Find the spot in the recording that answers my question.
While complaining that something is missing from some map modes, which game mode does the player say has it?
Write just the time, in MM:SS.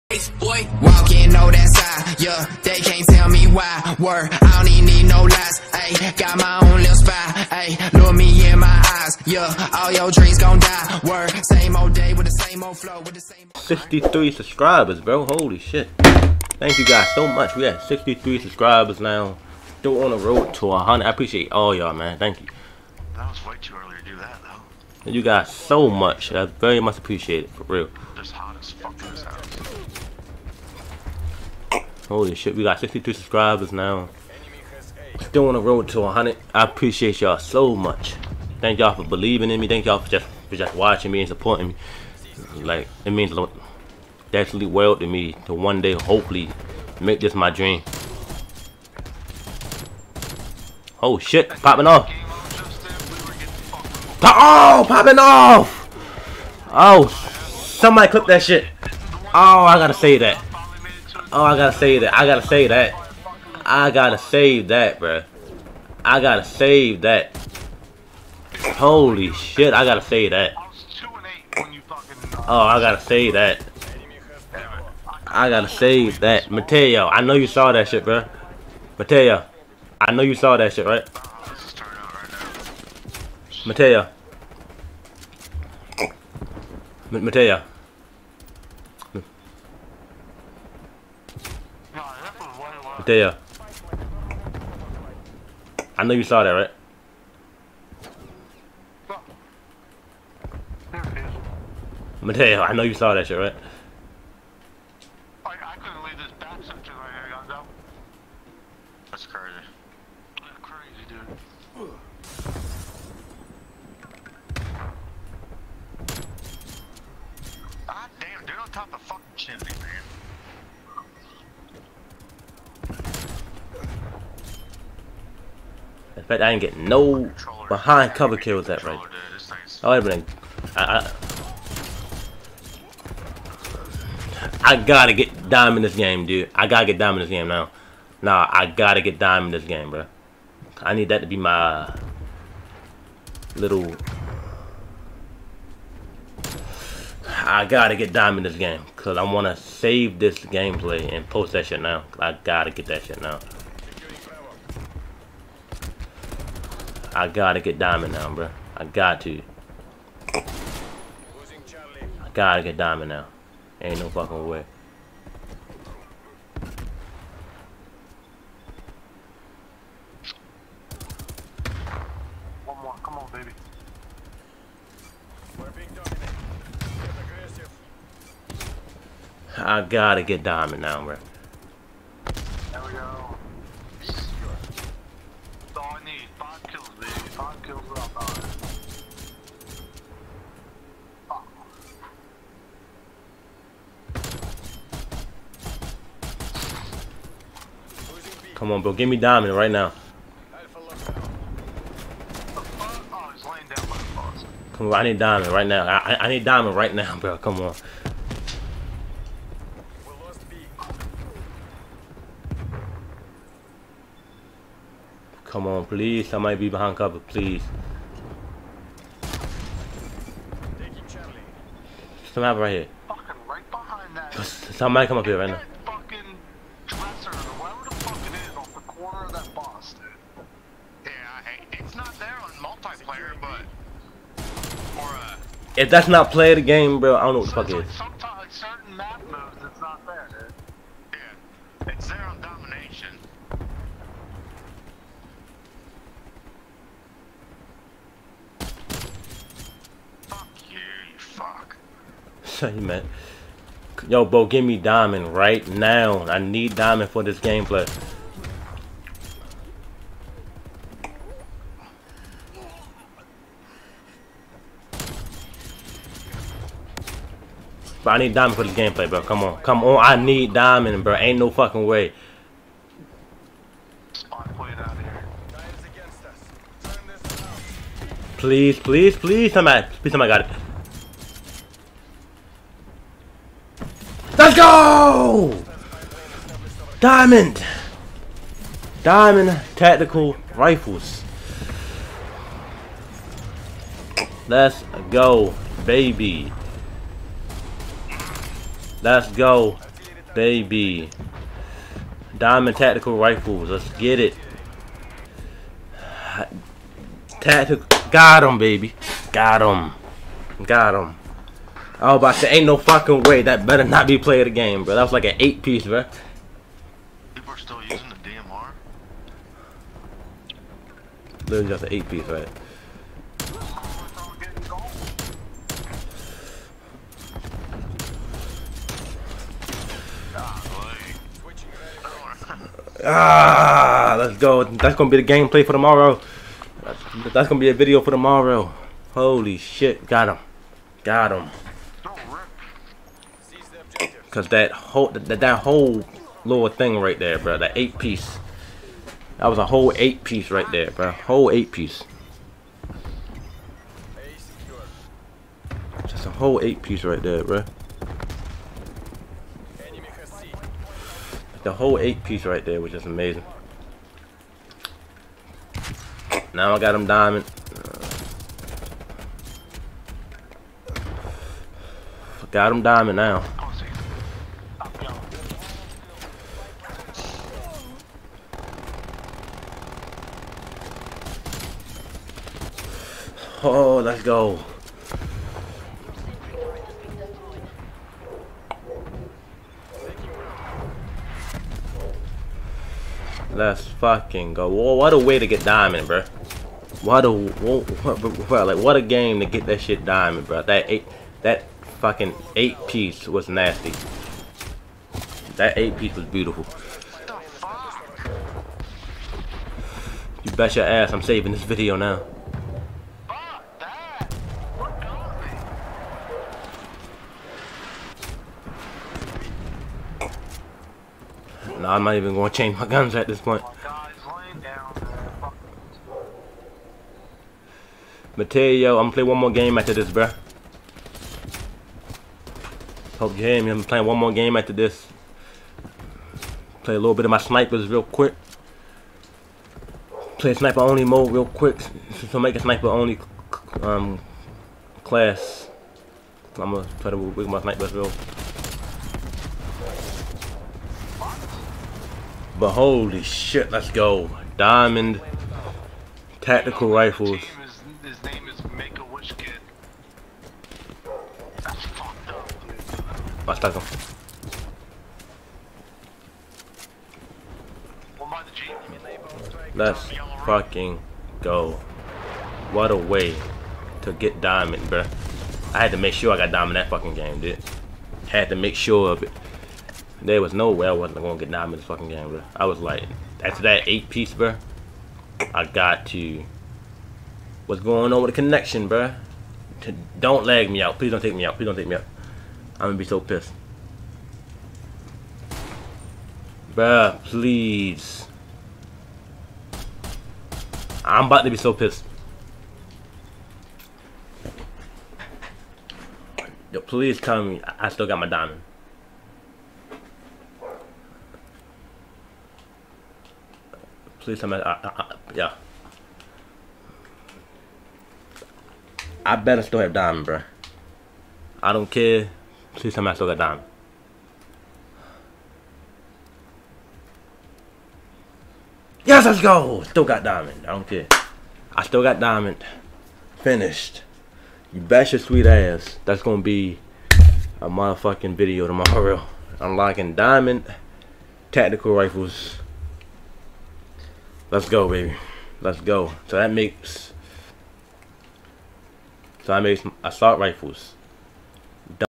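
04:02.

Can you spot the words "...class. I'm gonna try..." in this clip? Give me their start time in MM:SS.
07:25.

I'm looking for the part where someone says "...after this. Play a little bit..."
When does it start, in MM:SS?
07:14.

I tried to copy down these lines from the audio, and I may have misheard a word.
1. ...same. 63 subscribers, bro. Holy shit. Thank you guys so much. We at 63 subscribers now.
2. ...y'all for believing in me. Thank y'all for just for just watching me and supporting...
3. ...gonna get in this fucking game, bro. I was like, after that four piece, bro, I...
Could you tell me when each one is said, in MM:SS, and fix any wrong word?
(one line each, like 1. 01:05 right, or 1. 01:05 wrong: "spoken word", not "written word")
1. 00:13 right
2. 00:38 right
3. 08:01 wrong: "eight", not "four".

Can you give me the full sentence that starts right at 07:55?
I had to make sure I got diamond that fucking game, dude.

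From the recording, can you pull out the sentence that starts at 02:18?
Nah, I gotta get dime in this game, bro.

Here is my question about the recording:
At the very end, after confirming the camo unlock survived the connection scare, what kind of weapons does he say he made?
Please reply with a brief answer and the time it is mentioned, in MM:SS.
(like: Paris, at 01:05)
Assault rifles, at 09:10.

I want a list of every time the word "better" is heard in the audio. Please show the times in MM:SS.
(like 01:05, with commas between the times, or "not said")
05:13, 08:39.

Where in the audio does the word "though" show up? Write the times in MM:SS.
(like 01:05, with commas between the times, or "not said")
00:24.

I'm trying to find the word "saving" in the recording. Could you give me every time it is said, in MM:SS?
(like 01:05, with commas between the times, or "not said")
06:51.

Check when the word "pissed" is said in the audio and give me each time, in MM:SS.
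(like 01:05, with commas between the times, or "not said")
08:13, 08:21.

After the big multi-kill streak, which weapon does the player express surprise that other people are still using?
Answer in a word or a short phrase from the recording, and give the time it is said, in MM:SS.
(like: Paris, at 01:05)
DMR, at 05:18.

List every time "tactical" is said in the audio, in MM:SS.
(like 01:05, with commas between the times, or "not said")
04:49, 05:02, 05:07, 07:36, 09:01.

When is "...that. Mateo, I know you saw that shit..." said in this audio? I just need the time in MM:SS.
01:16.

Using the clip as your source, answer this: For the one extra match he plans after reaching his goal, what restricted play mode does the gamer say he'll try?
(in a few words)
Sniper only mode.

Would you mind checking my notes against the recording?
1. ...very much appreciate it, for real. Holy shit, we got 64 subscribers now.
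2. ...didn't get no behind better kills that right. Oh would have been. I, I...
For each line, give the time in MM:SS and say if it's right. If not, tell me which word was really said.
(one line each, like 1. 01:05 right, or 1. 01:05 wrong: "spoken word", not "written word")
1. 00:26 wrong: "62", not "64"
2. 02:06 wrong: "cover", not "better".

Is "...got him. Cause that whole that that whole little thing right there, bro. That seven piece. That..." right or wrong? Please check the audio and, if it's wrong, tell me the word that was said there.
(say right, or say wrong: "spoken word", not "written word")
wrong: "eight", not "seven".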